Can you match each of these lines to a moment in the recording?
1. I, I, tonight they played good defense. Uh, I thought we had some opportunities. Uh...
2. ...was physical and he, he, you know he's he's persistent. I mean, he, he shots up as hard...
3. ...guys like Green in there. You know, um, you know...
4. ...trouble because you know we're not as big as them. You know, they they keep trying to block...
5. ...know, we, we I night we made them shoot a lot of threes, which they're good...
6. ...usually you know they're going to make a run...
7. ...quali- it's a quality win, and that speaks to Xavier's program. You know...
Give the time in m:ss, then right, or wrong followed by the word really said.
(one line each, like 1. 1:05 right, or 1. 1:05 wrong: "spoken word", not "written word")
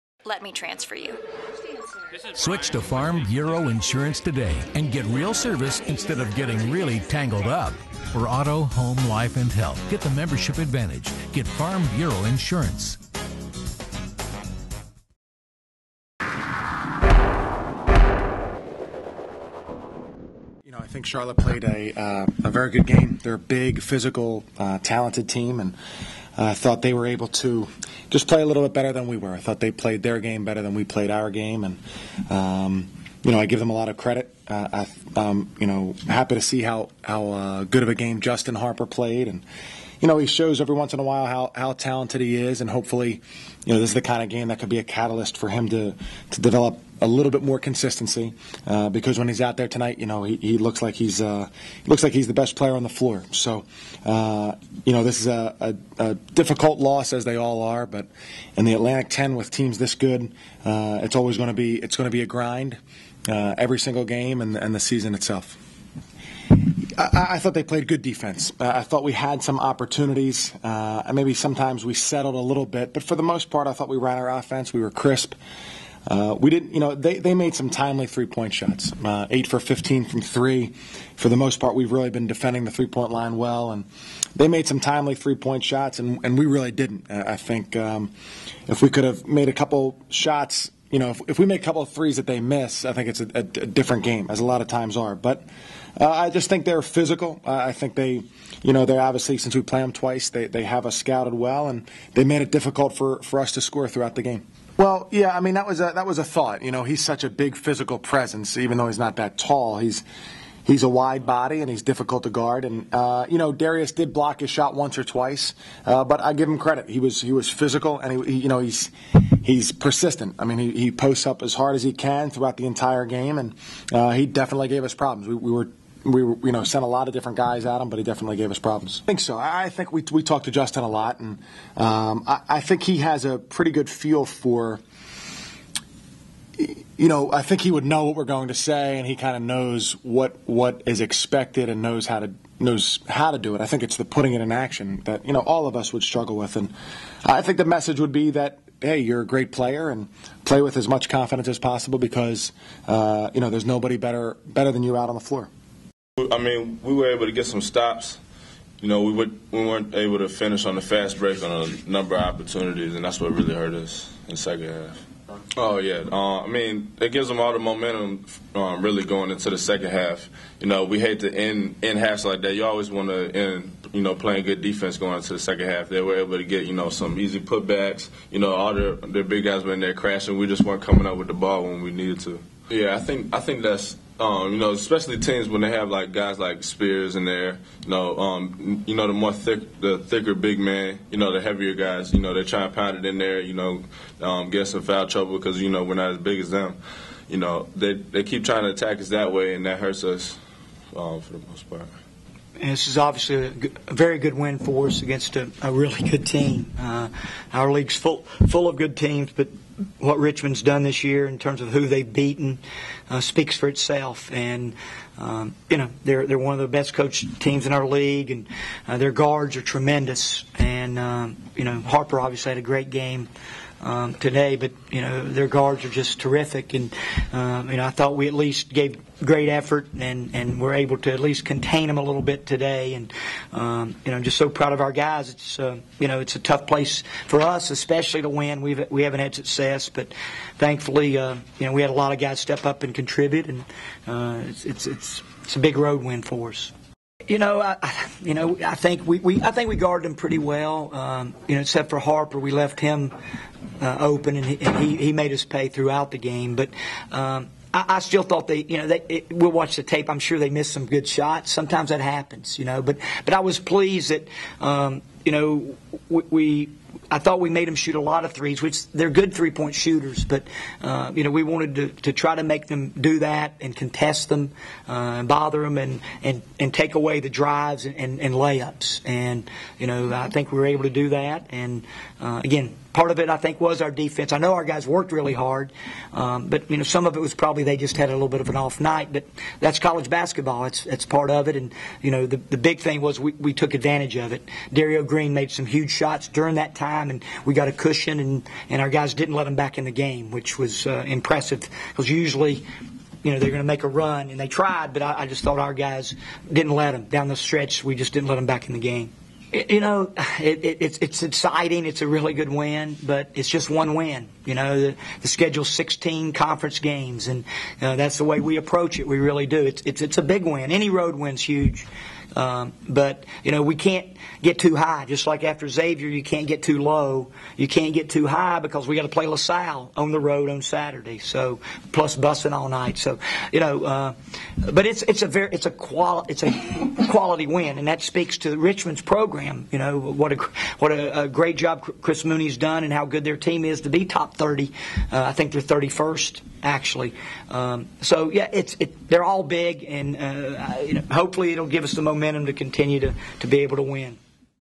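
1. 1:06 wrong: "thought", not "tonight"
2. 1:57 wrong: "posts", not "shots"
3. 3:06 wrong: "Spears", not "Green"
4. 3:15 wrong: "attack", not "block"
5. 4:25 wrong: "thought", not "night"
6. 5:02 right
7. 5:35 wrong: "Richmond", not "Xavier".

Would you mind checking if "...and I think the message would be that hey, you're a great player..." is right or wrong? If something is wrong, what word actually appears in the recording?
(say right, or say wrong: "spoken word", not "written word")
right.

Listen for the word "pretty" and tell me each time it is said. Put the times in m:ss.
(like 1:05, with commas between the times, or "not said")
2:13, 4:10.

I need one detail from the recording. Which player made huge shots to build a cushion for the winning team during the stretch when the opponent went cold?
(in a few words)
Derrio Green.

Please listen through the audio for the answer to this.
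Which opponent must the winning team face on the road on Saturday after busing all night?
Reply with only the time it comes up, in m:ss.
5:29.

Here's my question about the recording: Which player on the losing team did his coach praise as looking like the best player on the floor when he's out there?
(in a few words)
Justin Harper.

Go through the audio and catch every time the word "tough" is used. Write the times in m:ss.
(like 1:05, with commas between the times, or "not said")
3:56.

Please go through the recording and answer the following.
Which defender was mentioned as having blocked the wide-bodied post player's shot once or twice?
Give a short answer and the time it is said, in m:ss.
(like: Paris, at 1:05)
Darius, at 1:53.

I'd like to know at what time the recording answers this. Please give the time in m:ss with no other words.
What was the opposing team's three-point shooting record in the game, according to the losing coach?
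1:19.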